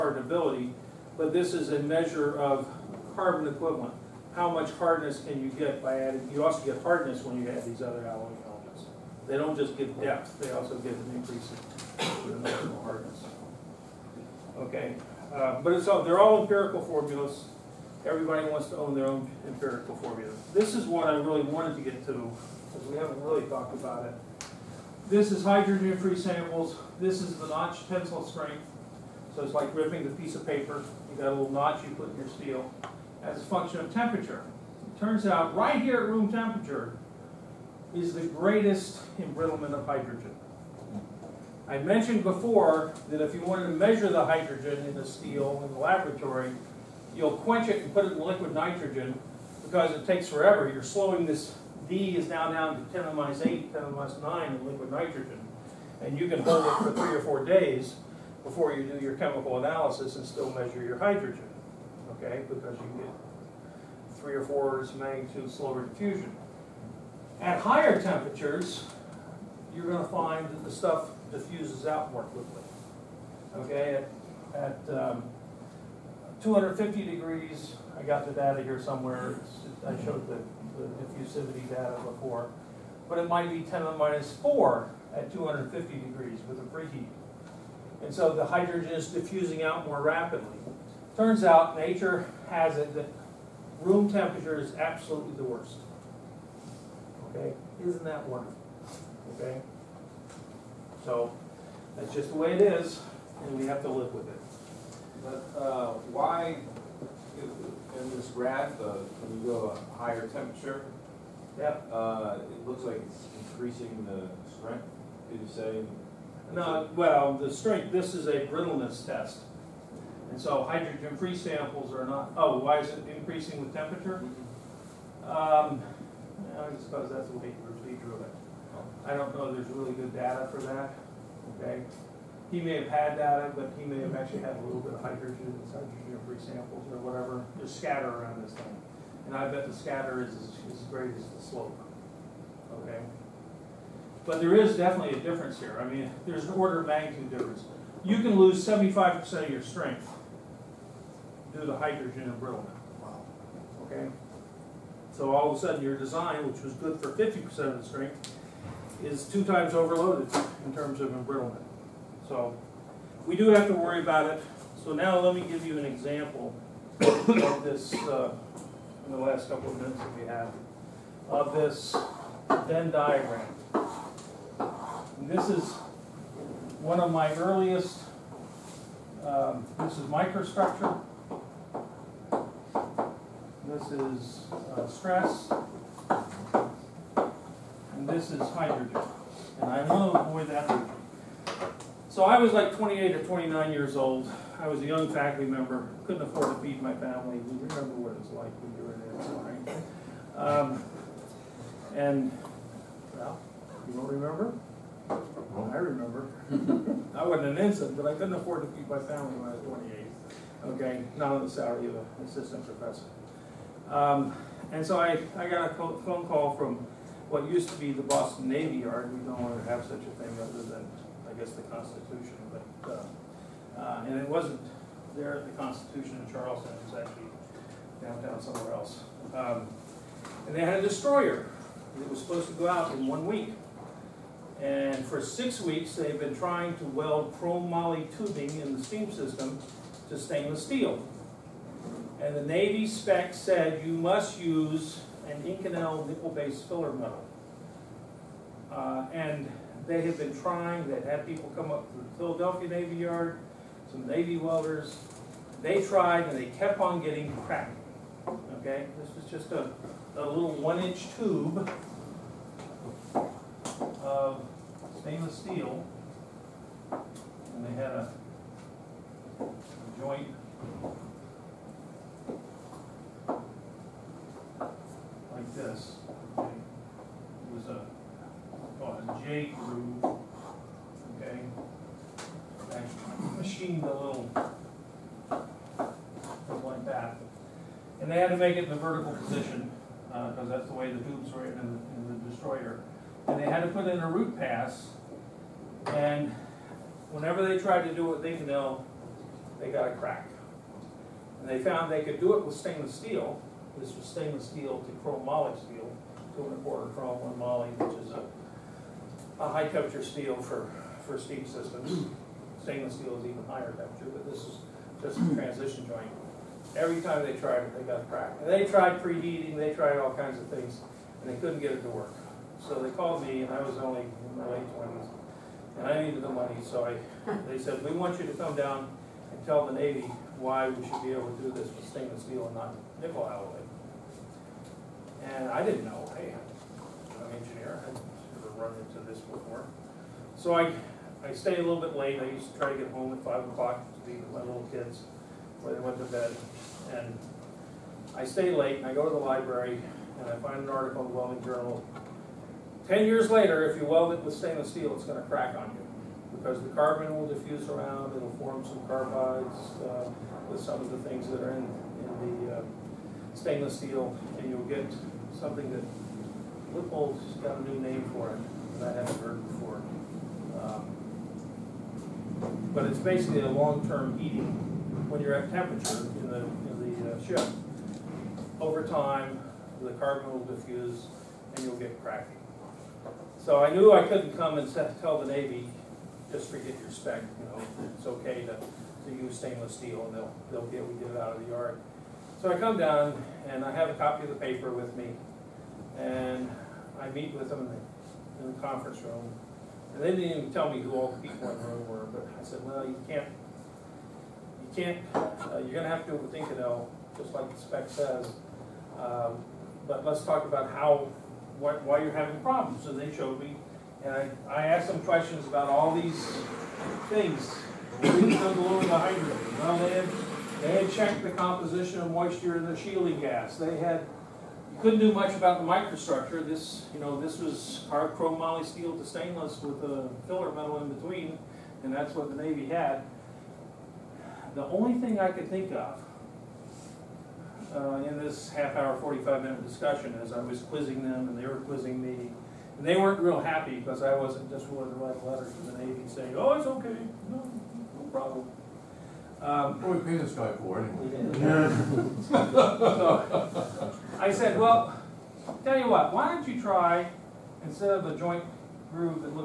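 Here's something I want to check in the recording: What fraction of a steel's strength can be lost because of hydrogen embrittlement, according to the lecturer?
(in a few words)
75%.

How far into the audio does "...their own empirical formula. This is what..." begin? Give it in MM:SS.
00:18.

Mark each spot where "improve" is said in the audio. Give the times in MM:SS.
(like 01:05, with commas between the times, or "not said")
not said.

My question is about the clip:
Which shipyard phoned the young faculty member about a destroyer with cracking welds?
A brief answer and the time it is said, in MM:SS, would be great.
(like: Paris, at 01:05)
Boston Navy Yard, at 03:38.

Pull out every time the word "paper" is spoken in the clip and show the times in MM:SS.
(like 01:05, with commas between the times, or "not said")
00:30, 06:34.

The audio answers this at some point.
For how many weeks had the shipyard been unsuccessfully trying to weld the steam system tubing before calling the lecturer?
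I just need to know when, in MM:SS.
03:55.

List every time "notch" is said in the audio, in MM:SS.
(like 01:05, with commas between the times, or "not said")
00:27, 00:31.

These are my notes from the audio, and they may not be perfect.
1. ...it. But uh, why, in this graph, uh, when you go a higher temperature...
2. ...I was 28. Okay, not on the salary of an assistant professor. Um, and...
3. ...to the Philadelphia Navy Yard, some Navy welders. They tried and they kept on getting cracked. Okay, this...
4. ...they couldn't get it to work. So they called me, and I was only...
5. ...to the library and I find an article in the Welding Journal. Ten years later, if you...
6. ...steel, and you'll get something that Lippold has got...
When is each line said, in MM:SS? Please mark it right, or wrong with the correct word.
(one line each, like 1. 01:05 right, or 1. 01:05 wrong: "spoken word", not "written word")
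1. 01:44 right
2. 03:29 right
3. 04:11 right
4. 05:21 right
5. 05:49 right
6. 06:03 right.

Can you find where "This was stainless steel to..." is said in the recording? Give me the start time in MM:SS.
05:03.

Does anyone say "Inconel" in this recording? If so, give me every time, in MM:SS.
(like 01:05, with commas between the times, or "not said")
04:05, 06:46.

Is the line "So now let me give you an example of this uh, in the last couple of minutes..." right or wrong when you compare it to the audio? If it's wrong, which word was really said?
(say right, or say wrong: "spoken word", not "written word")
right.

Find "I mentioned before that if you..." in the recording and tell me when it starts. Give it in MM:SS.
00:41.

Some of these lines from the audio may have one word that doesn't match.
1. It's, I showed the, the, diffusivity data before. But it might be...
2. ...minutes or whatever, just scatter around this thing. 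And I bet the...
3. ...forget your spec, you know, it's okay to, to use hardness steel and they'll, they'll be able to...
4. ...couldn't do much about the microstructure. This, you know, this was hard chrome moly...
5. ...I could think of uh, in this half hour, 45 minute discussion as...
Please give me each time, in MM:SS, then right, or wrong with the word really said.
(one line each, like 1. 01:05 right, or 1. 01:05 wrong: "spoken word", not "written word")
1. 01:19 right
2. 02:16 wrong: "samples", not "minutes"
3. 06:26 wrong: "stainless", not "hardness"
4. 07:04 right
5. 07:15 right.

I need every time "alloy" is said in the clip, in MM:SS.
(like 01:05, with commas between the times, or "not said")
00:08, 05:33.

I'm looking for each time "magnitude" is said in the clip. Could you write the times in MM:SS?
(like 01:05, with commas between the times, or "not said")
01:04, 02:26.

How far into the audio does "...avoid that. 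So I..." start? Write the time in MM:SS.
03:10.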